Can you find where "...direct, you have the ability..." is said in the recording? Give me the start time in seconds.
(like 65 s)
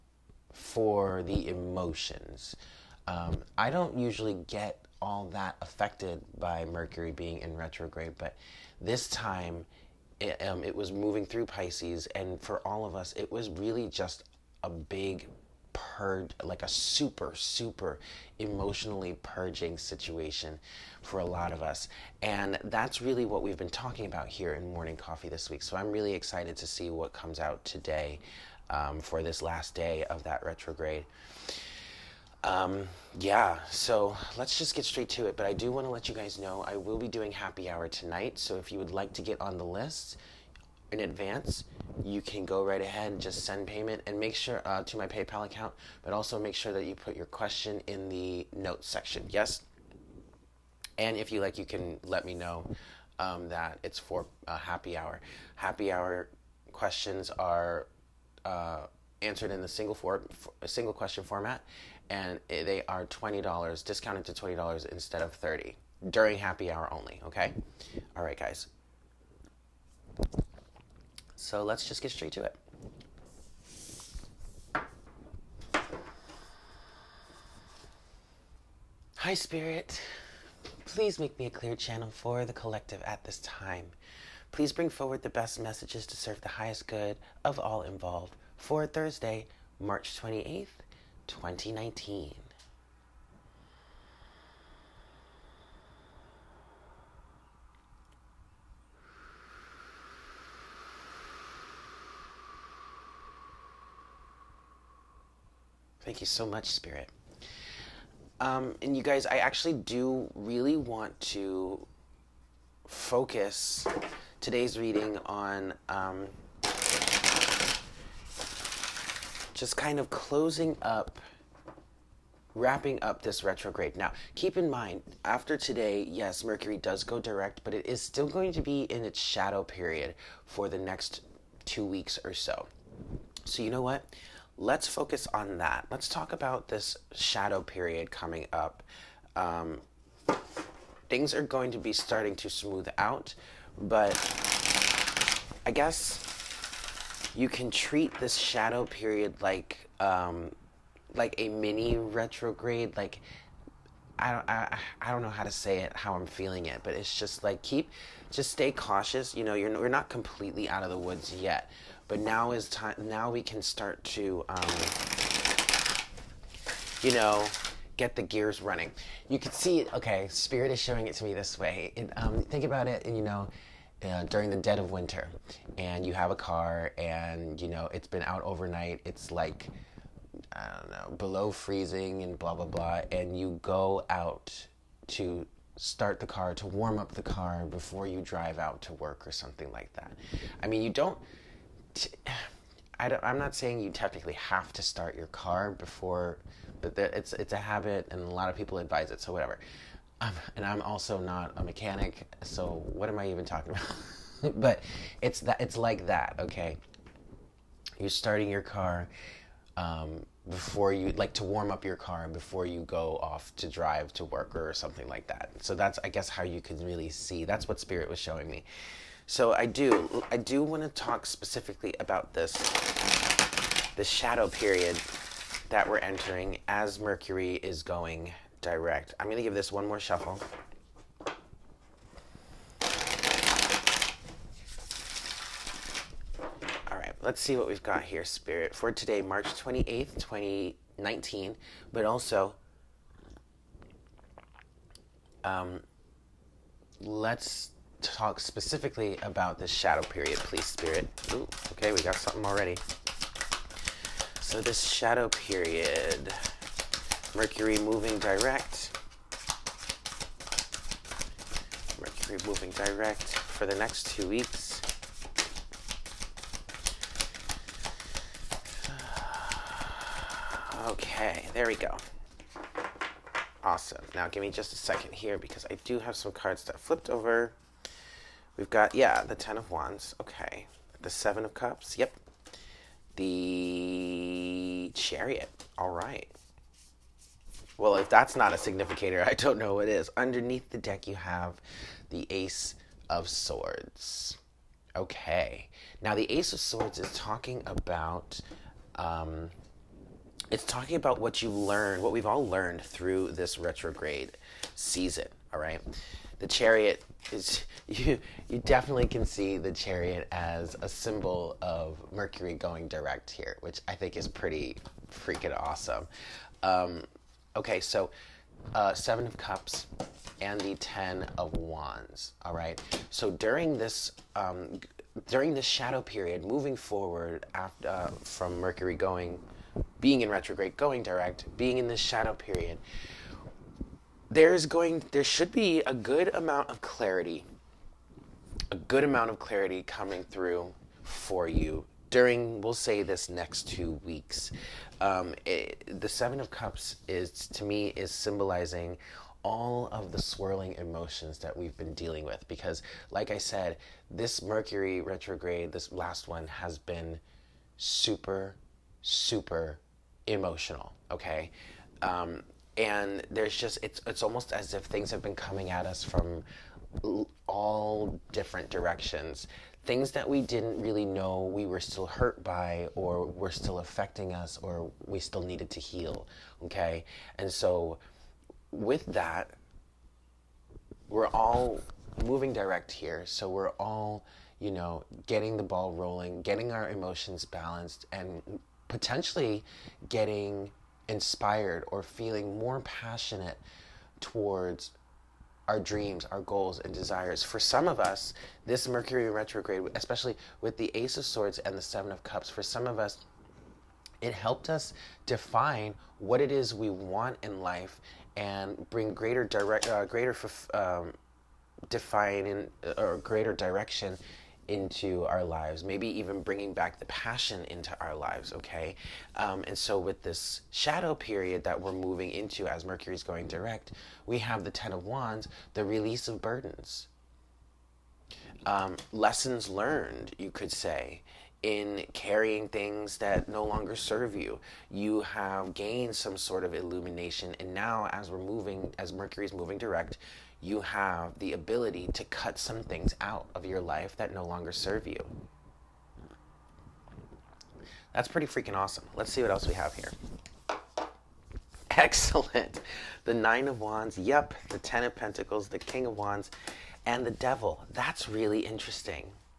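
439 s.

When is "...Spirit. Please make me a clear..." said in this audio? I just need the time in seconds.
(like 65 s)
79 s.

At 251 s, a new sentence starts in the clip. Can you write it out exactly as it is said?
Ooh, okay, we got something already.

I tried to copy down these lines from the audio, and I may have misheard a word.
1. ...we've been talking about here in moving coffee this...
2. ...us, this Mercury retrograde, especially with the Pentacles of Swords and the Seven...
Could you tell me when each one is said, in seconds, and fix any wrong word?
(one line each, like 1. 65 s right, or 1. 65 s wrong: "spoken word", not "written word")
1. 23 s wrong: "morning", not "moving"
2. 398 s wrong: "Ace", not "Pentacles".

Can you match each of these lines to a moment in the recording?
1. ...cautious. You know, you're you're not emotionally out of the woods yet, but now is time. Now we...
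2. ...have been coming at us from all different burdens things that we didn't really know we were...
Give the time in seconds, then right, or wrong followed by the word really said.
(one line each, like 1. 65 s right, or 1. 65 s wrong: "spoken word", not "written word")
1. 158 s wrong: "completely", not "emotionally"
2. 365 s wrong: "directions", not "burdens".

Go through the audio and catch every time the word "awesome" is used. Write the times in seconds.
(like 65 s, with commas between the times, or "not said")
273 s, 315 s, 448 s.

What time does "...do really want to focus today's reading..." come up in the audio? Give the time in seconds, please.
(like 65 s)
109 s.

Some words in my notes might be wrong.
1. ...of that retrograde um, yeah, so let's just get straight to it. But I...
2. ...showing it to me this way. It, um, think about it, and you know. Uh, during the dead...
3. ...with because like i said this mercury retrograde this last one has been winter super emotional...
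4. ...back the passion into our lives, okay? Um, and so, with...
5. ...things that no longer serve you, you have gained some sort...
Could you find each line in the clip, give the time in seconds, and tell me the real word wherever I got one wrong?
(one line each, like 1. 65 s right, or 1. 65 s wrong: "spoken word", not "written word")
1. 30 s right
2. 170 s right
3. 352 s wrong: "super", not "winter"
4. 416 s right
5. 432 s right.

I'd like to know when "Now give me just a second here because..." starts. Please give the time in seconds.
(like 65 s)
274 s.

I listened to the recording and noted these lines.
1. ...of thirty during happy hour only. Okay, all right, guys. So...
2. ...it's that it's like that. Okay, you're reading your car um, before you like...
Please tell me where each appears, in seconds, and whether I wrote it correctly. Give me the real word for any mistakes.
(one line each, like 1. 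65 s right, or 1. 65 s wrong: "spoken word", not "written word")
1. 65 s right
2. 205 s wrong: "starting", not "reading".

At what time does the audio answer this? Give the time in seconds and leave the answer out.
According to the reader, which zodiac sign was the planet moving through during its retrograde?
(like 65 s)
11 s.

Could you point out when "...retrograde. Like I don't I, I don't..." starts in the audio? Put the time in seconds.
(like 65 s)
151 s.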